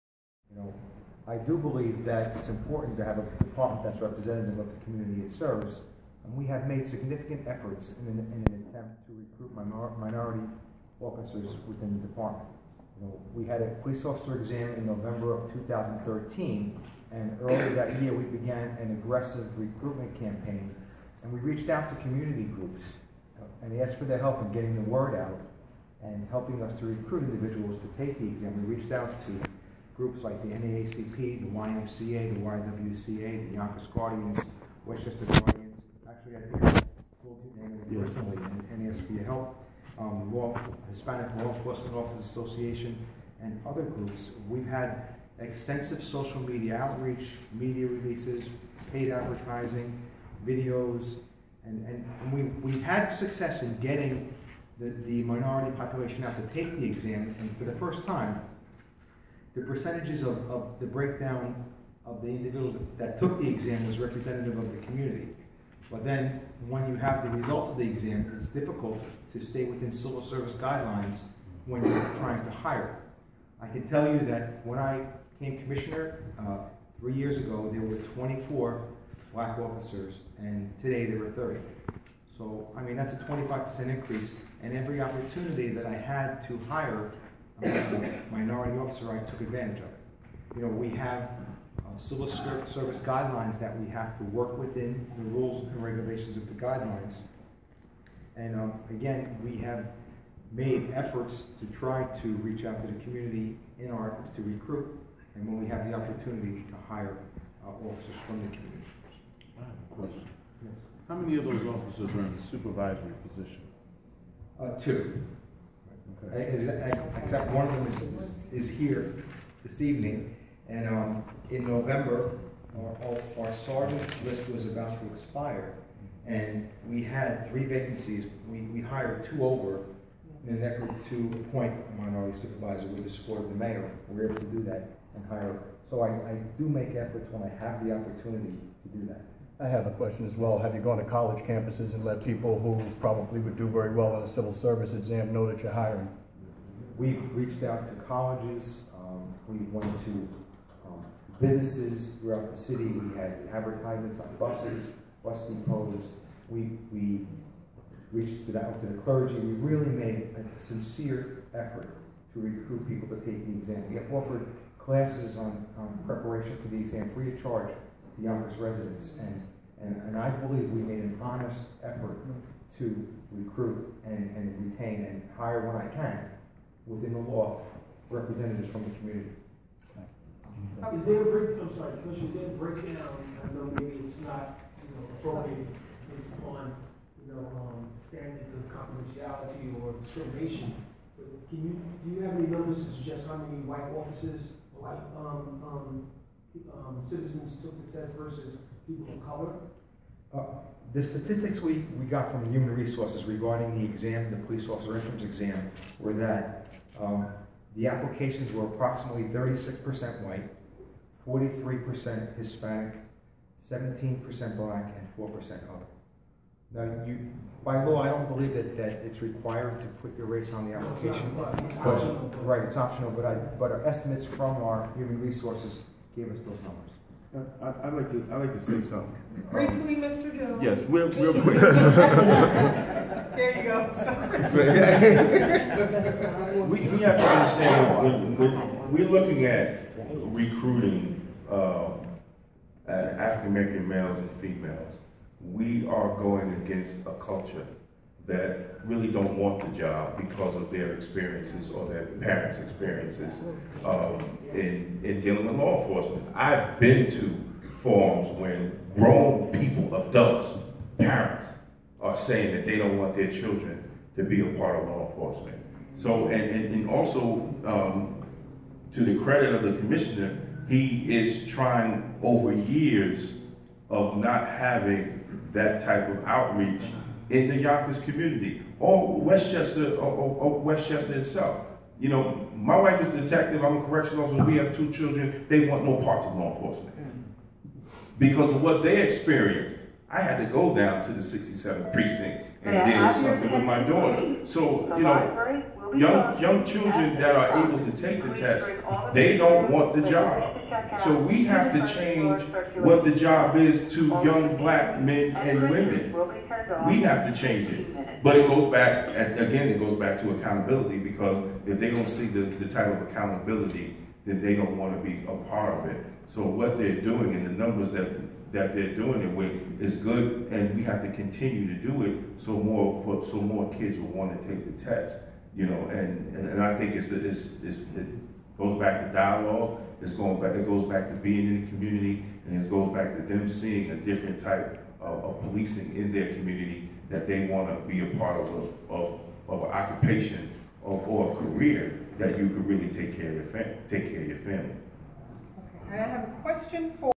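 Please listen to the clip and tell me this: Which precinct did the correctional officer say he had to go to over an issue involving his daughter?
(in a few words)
67th precinct.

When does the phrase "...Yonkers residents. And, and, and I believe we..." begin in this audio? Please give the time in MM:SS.
02:48.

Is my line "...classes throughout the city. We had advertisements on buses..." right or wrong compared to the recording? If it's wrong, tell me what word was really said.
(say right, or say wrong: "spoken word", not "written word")
wrong: "businesses", not "classes".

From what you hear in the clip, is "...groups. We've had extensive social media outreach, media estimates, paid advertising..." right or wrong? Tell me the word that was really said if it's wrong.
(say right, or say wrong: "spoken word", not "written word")
wrong: "releases", not "estimates".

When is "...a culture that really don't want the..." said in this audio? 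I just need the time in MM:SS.
04:07.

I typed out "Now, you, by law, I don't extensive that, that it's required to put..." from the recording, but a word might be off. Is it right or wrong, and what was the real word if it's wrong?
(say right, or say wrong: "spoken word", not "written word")
wrong: "believe", not "extensive".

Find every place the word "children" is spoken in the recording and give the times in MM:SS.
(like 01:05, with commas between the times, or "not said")
04:23, 04:44, 04:56.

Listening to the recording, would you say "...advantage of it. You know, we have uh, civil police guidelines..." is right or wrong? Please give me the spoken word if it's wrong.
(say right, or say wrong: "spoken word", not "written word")
wrong: "service", not "police".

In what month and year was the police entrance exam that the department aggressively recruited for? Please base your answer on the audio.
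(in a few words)
November 2013.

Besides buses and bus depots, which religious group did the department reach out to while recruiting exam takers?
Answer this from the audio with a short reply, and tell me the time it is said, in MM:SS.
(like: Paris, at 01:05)
The clergy, at 02:39.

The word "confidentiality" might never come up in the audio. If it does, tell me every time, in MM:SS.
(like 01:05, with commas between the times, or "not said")
03:08.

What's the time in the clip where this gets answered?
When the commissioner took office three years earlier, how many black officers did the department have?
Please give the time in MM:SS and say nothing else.
01:17.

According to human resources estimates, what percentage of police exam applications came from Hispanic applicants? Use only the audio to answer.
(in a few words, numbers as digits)
43%.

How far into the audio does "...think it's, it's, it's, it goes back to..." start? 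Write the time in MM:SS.
05:26.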